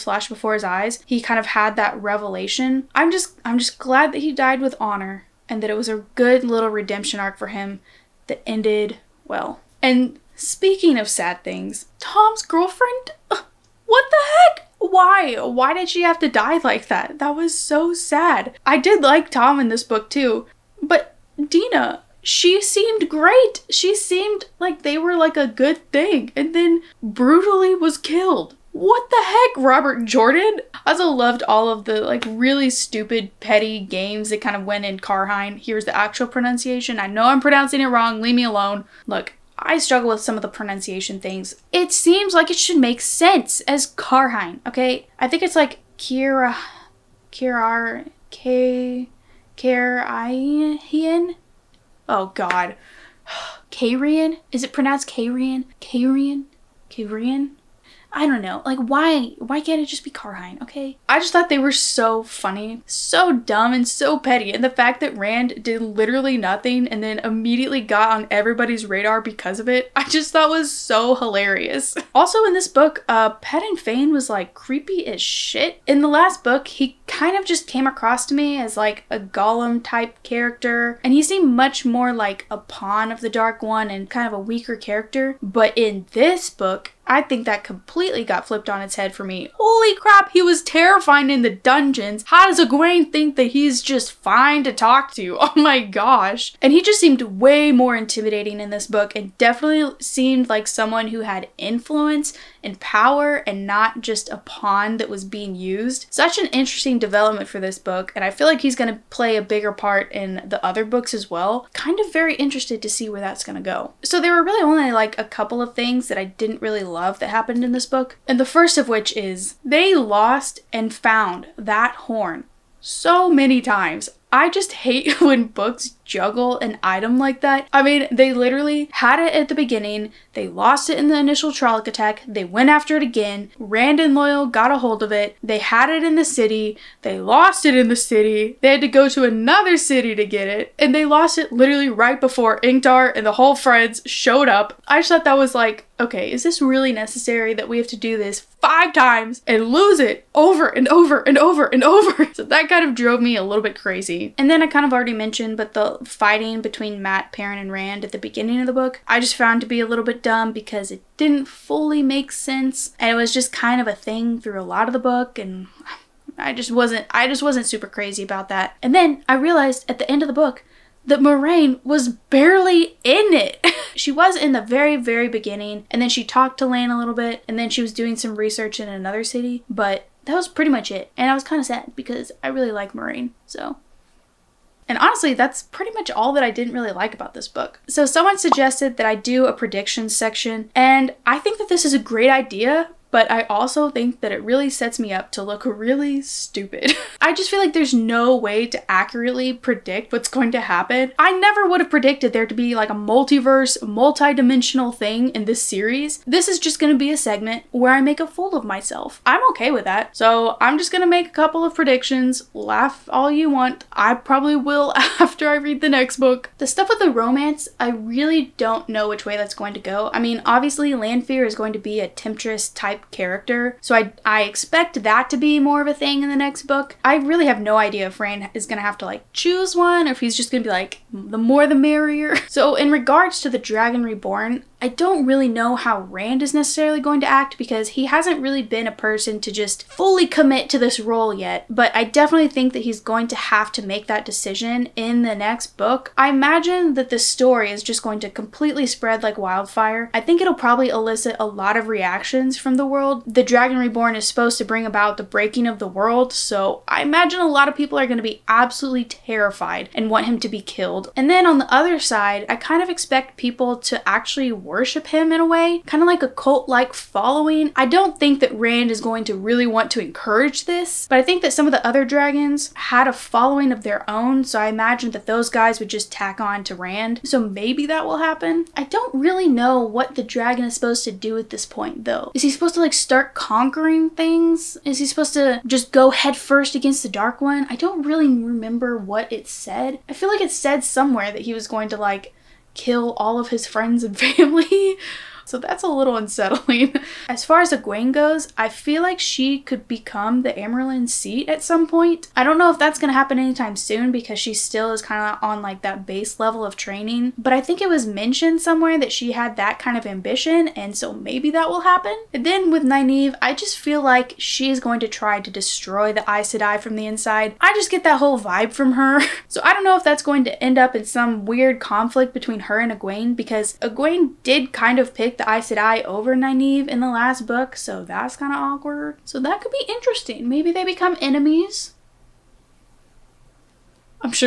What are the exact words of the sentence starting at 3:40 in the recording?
I mean, obviously Lanfear is going to be a temptress type character.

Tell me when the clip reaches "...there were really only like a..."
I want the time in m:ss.
1:54.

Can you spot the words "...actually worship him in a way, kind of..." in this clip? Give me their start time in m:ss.
4:24.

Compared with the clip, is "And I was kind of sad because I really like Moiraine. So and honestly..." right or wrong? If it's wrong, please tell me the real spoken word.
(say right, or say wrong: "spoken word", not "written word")
right.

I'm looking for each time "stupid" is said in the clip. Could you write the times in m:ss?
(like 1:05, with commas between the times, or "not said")
0:32, 3:16.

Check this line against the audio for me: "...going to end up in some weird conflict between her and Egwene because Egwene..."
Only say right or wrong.
right.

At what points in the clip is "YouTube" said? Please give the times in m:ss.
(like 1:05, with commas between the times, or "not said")
not said.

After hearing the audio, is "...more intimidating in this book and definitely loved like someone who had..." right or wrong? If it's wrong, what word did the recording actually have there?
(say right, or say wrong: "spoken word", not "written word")
wrong: "seemed", not "loved".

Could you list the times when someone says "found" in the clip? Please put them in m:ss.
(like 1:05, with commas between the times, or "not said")
2:00, 2:39.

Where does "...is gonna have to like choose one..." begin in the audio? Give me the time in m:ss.
3:48.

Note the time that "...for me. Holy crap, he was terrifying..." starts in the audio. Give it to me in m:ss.
1:29.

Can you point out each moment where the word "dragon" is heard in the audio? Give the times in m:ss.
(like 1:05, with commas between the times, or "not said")
3:53, 4:13, 4:32, 4:40.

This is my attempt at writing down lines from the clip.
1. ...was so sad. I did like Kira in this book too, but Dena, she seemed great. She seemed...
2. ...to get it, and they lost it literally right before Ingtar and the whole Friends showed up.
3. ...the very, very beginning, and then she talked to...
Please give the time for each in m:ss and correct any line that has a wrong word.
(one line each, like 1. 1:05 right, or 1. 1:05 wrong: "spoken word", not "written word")
1. 0:17 wrong: "Thom", not "Kira"
2. 2:20 right
3. 2:54 right.